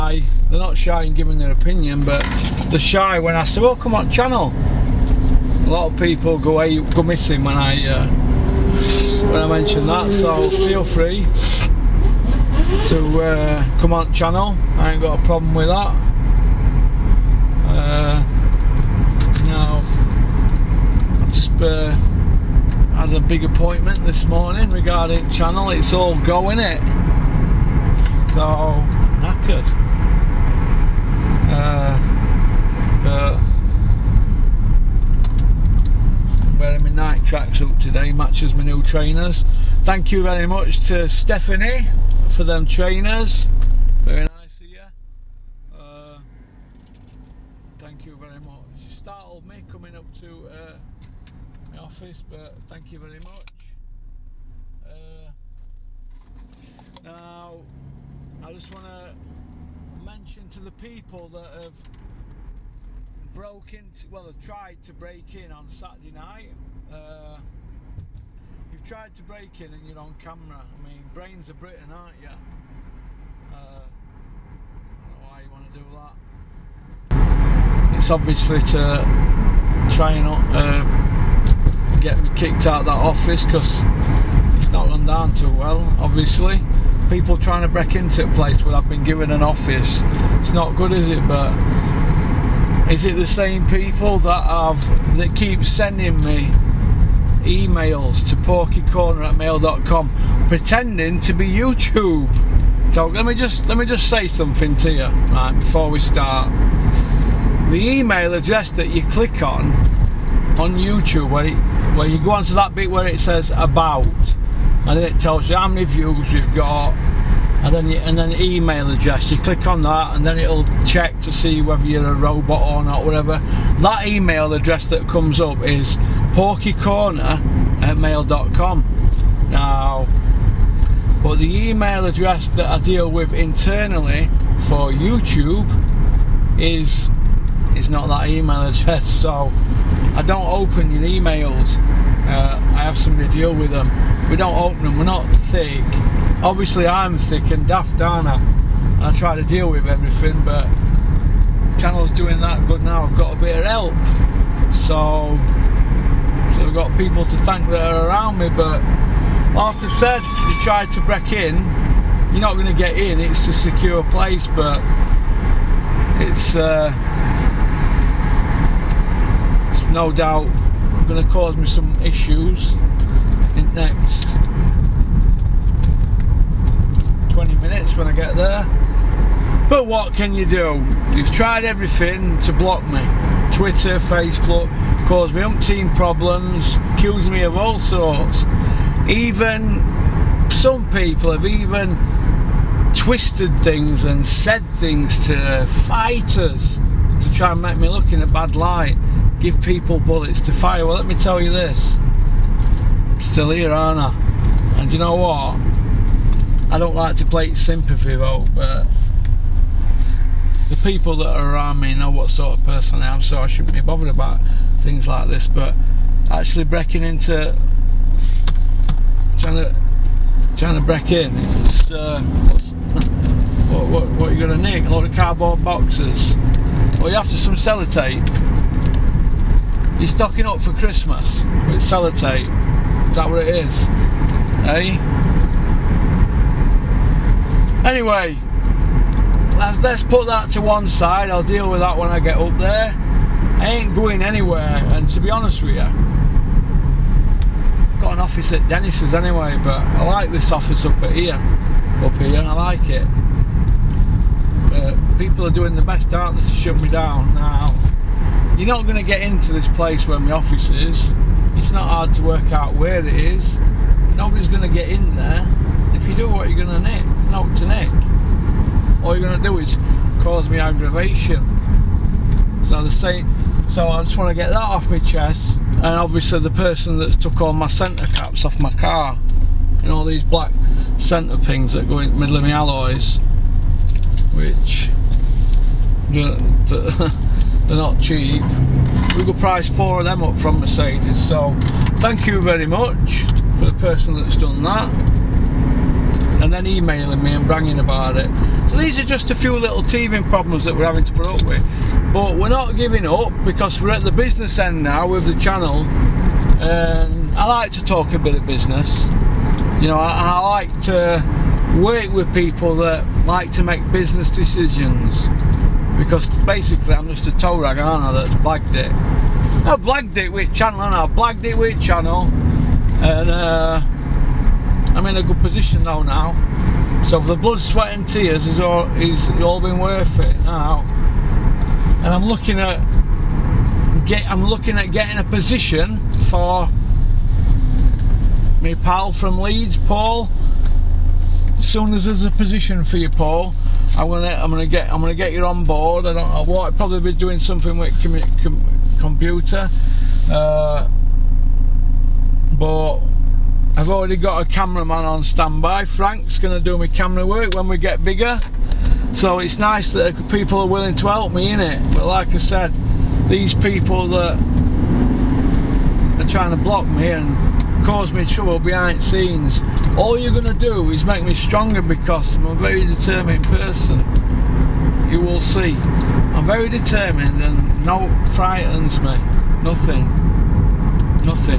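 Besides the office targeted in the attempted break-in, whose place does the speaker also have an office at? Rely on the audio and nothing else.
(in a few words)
Dennis's.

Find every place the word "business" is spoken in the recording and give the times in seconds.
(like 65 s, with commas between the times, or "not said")
304 s, 308 s, 313 s.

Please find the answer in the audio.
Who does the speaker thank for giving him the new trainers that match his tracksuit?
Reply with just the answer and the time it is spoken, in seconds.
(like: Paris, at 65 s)
Stephanie, at 41 s.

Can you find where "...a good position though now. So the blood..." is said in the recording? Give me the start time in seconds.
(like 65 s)
325 s.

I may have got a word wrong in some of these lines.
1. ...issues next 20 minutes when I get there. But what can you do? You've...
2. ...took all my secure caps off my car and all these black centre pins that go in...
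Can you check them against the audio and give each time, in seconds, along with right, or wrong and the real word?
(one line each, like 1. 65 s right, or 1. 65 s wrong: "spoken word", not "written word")
1. 172 s right
2. 277 s wrong: "centre", not "secure".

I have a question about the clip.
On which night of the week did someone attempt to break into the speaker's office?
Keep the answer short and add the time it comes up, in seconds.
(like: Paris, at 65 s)
Saturday, at 65 s.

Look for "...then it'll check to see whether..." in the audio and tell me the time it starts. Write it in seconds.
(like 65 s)
120 s.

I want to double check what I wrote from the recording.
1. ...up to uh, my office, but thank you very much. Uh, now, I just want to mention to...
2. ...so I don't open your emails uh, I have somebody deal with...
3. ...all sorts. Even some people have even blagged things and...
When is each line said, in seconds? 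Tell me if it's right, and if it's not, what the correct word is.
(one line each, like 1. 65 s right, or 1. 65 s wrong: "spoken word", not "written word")
1. 49 s right
2. 139 s right
3. 187 s wrong: "twisted", not "blagged".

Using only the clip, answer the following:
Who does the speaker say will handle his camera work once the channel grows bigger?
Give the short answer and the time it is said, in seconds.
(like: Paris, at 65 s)
Frank, at 355 s.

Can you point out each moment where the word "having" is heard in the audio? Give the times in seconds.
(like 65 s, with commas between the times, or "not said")
300 s.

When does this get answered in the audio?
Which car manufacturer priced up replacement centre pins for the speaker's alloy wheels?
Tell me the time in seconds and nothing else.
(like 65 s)
290 s.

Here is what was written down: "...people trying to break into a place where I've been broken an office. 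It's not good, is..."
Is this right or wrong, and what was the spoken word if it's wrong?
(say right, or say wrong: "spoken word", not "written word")
wrong: "given", not "broken".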